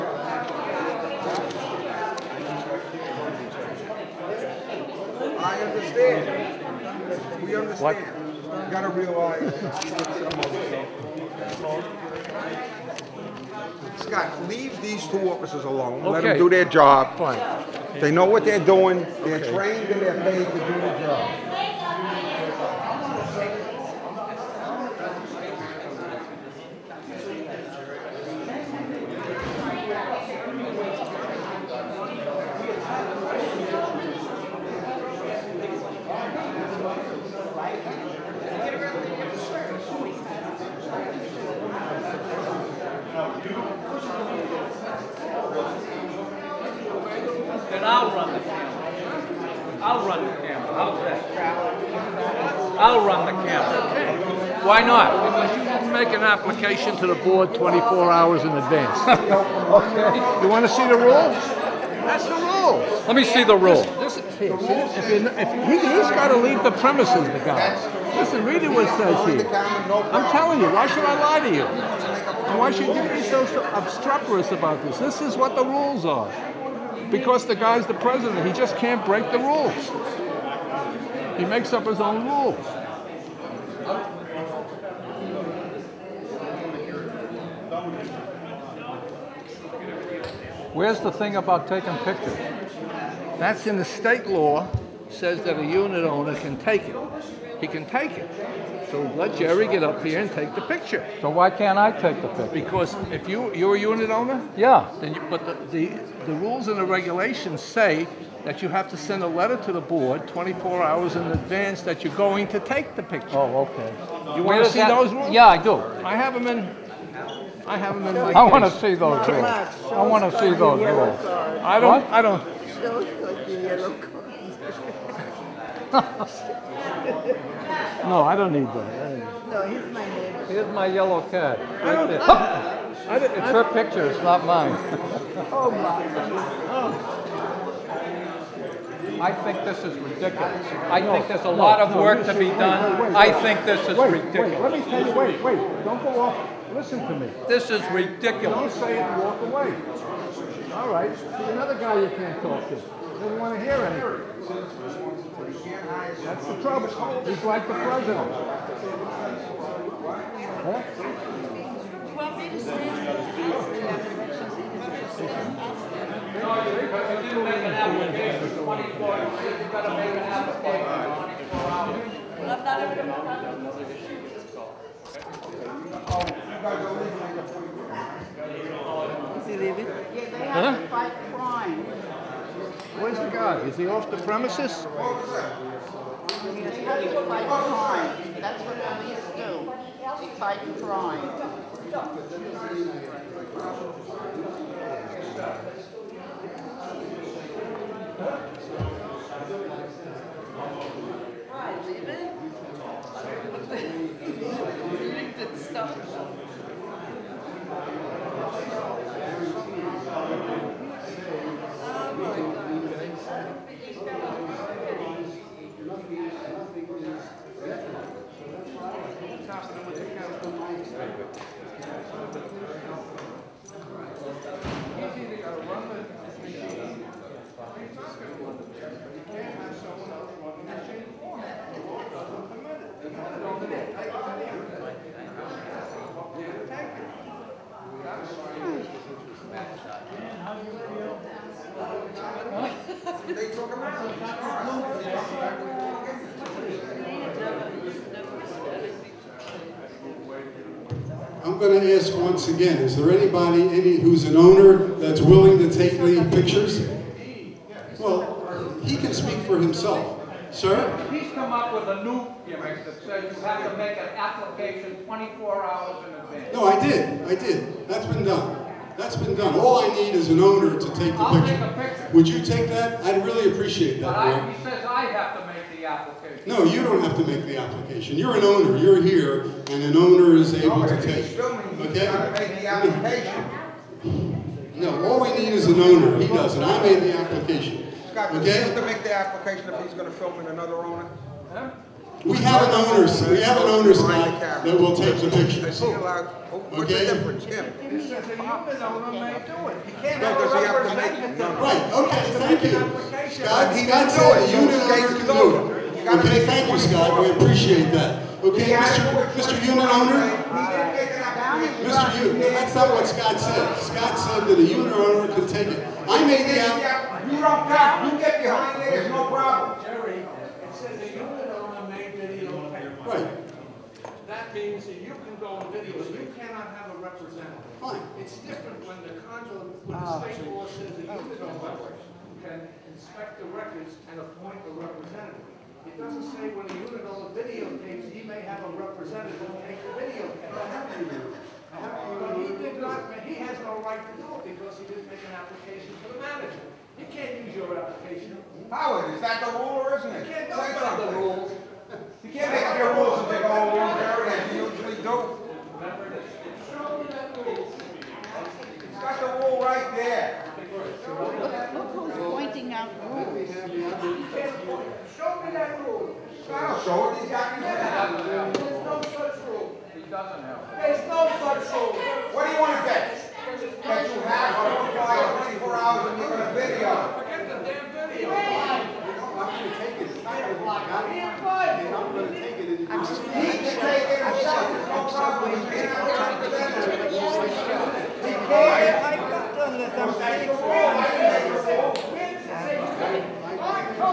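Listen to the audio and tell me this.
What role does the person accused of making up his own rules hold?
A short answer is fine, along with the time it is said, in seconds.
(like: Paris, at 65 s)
president, at 77 s.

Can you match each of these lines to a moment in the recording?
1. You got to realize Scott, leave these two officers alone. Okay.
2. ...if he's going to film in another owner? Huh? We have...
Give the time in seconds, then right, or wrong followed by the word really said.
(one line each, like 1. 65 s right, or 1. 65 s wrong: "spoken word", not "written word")
1. 8 s right
2. 289 s right.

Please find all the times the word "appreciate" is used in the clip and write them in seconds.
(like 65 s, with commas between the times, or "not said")
273 s, 307 s.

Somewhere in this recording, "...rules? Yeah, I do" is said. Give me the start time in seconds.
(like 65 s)
115 s.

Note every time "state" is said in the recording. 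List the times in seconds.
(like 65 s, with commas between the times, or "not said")
93 s, 330 s.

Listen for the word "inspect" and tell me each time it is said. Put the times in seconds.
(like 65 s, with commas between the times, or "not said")
332 s.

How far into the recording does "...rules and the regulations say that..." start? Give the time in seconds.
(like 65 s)
106 s.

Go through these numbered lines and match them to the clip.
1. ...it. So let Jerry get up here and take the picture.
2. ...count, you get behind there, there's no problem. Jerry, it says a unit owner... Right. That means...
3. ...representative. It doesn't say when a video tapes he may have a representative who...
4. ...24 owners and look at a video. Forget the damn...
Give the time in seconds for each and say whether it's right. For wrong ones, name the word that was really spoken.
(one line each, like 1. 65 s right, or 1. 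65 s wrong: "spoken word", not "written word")
1. 98 s right
2. 317 s right
3. 334 s right
4. 375 s wrong: "hours", not "owners".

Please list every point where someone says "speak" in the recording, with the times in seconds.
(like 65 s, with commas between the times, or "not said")
259 s.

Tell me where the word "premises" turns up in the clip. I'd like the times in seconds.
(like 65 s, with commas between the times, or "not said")
66 s, 184 s.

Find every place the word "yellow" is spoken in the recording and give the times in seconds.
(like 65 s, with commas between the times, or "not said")
123 s, 130 s.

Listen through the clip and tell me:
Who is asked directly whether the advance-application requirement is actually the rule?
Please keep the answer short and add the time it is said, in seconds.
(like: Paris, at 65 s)
Howard, at 348 s.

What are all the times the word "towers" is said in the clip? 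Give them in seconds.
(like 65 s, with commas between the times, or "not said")
not said.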